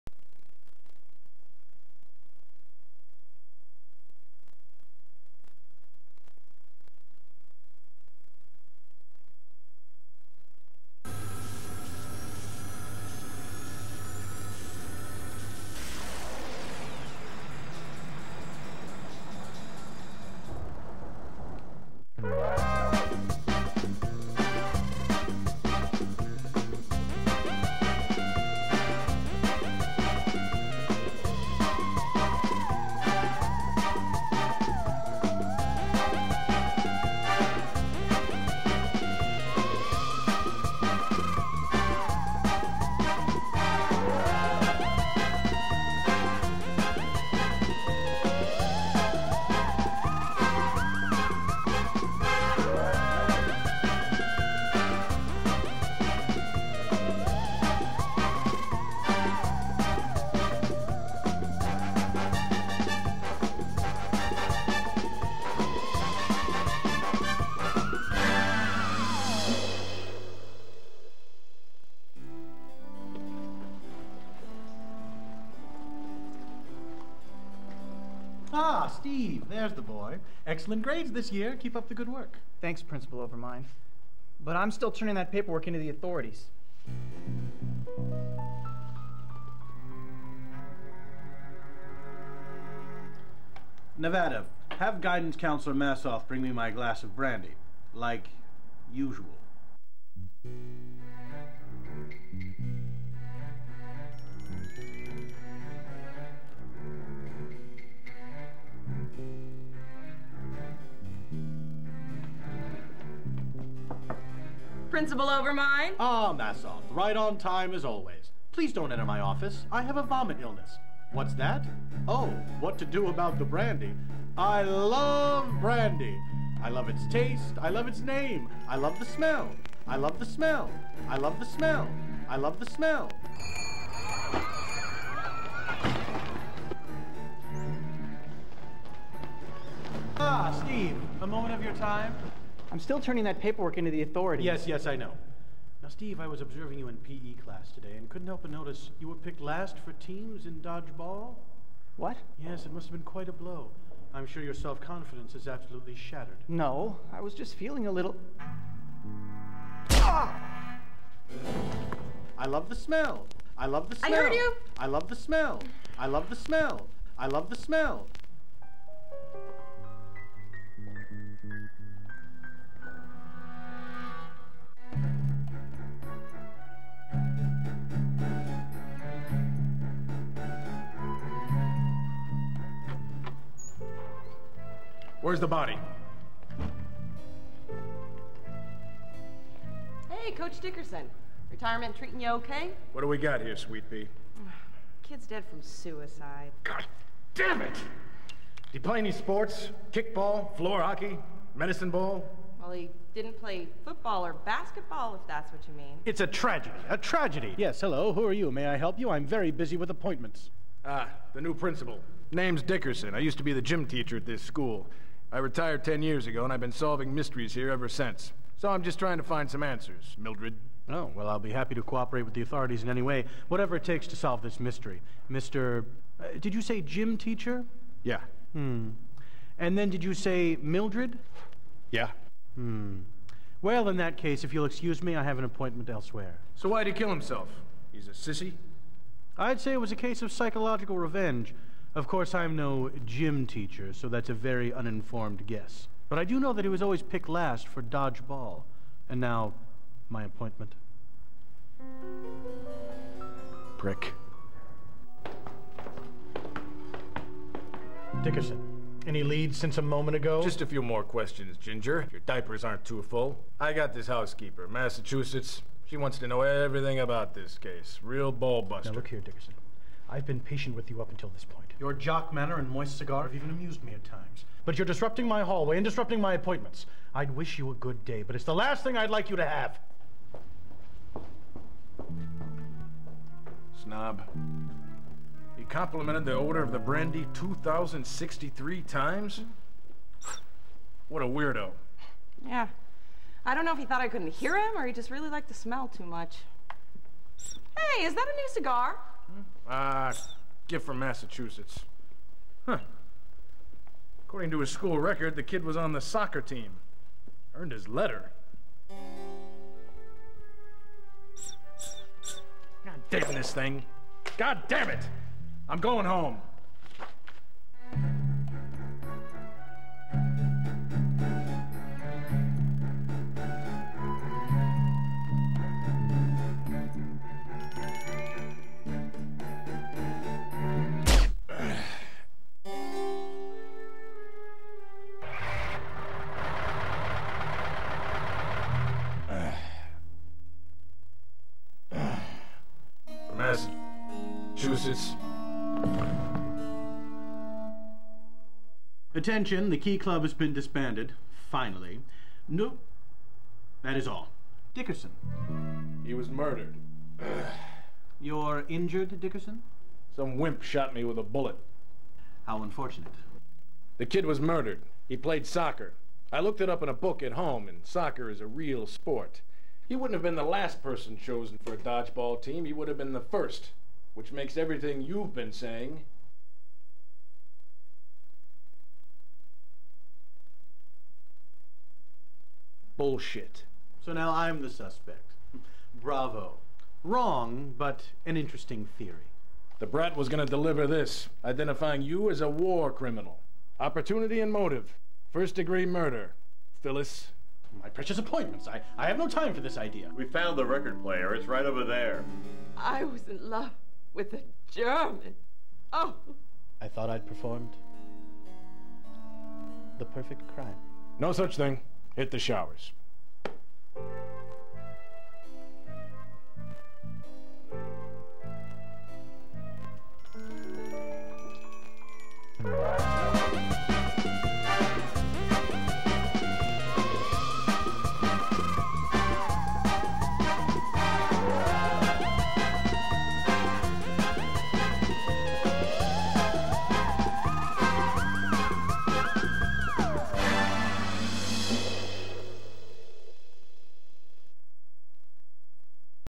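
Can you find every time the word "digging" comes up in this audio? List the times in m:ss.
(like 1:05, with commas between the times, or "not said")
not said.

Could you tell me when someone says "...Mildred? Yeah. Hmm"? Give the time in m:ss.
3:50.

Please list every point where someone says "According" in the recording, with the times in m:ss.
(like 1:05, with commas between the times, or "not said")
5:04.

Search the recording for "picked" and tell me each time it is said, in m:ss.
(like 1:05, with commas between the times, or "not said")
2:29, 4:07.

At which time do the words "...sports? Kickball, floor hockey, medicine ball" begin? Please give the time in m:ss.
3:19.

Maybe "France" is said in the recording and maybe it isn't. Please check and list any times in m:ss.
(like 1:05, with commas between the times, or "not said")
not said.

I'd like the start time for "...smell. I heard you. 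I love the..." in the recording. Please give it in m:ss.
2:43.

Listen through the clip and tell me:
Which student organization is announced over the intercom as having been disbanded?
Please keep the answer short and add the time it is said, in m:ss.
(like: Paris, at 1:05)
Key Club, at 5:49.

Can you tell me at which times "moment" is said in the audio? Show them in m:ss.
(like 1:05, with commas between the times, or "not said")
2:21, 4:19.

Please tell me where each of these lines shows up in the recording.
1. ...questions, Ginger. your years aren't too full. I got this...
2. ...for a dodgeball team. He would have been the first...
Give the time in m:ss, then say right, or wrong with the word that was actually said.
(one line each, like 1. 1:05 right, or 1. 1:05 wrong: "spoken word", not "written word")
1. 4:21 wrong: "diapers", not "years"
2. 6:11 right.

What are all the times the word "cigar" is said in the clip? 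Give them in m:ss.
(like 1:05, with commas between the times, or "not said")
4:32, 4:58.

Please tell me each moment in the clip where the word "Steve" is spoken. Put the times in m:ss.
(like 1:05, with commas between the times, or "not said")
1:19, 2:20, 2:25.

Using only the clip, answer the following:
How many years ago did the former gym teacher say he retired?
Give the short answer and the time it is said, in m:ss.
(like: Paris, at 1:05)
10, at 3:35.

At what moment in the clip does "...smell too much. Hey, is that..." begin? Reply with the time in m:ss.
4:55.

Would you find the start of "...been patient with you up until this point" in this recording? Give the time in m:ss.
4:30.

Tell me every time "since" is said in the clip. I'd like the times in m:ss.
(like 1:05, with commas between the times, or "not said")
3:37, 4:19.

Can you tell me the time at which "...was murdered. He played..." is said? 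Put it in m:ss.
6:04.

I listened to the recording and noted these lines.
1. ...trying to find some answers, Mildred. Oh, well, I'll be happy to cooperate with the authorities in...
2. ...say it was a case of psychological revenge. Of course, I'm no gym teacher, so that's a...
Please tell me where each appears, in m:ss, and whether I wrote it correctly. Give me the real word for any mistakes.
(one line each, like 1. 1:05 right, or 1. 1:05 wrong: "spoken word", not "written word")
1. 3:38 right
2. 3:59 right.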